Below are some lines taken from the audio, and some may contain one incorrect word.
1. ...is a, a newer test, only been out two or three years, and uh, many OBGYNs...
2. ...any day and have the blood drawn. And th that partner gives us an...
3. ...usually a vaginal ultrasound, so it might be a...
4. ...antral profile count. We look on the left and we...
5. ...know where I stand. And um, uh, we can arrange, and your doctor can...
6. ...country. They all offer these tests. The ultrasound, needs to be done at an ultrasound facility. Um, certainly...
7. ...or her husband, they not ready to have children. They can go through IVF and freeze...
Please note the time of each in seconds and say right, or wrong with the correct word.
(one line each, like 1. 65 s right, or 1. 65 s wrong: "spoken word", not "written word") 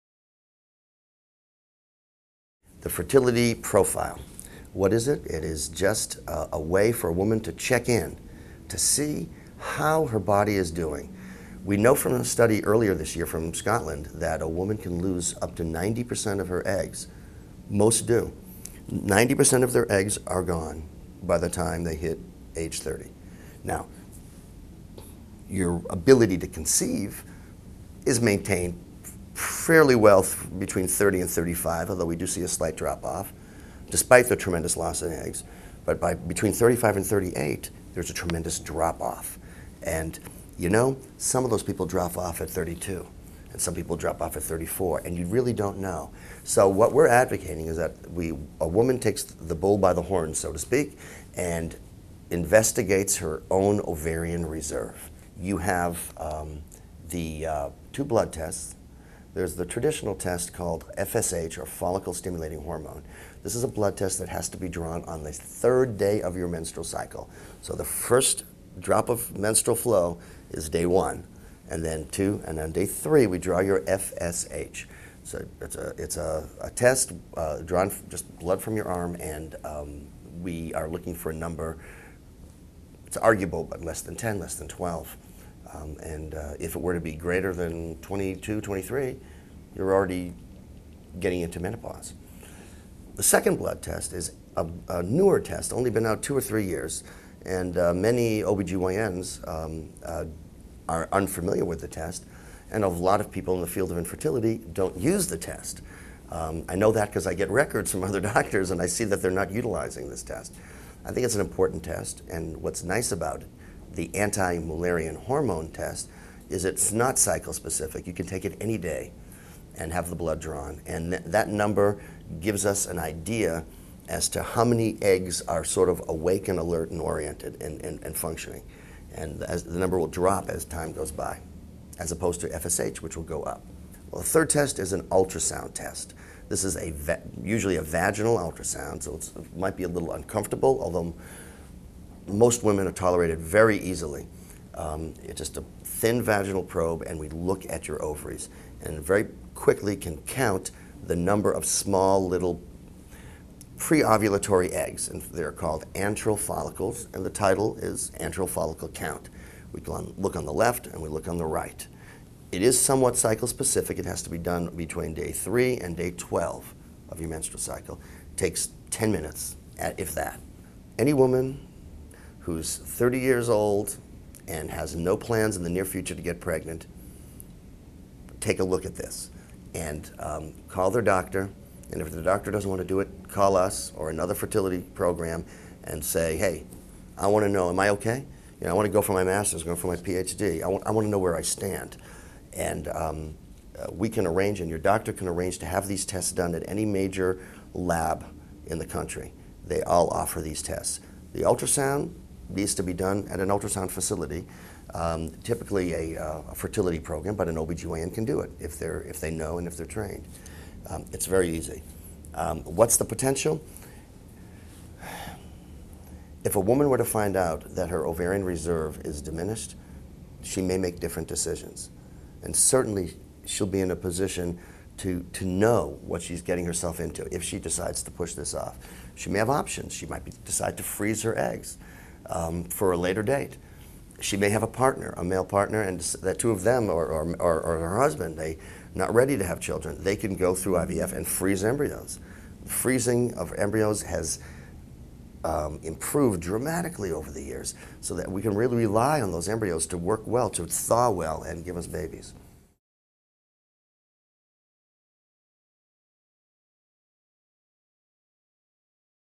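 1. 94 s right
2. 118 s wrong: "number", not "partner"
3. 137 s right
4. 158 s wrong: "follicle", not "profile"
5. 191 s right
6. 198 s wrong: "typically", not "certainly"
7. 237 s right.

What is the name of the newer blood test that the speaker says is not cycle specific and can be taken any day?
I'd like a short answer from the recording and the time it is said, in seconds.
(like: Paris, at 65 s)
Anti-mullerian hormone test, at 114 s.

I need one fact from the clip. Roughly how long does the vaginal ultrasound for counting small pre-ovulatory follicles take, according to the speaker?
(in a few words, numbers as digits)
10 minutes.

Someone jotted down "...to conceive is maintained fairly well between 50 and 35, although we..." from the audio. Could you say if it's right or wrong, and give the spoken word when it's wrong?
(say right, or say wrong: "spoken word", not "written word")
wrong: "30", not "50".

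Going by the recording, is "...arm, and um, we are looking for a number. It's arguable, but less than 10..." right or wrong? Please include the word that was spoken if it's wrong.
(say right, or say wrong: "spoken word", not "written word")
right.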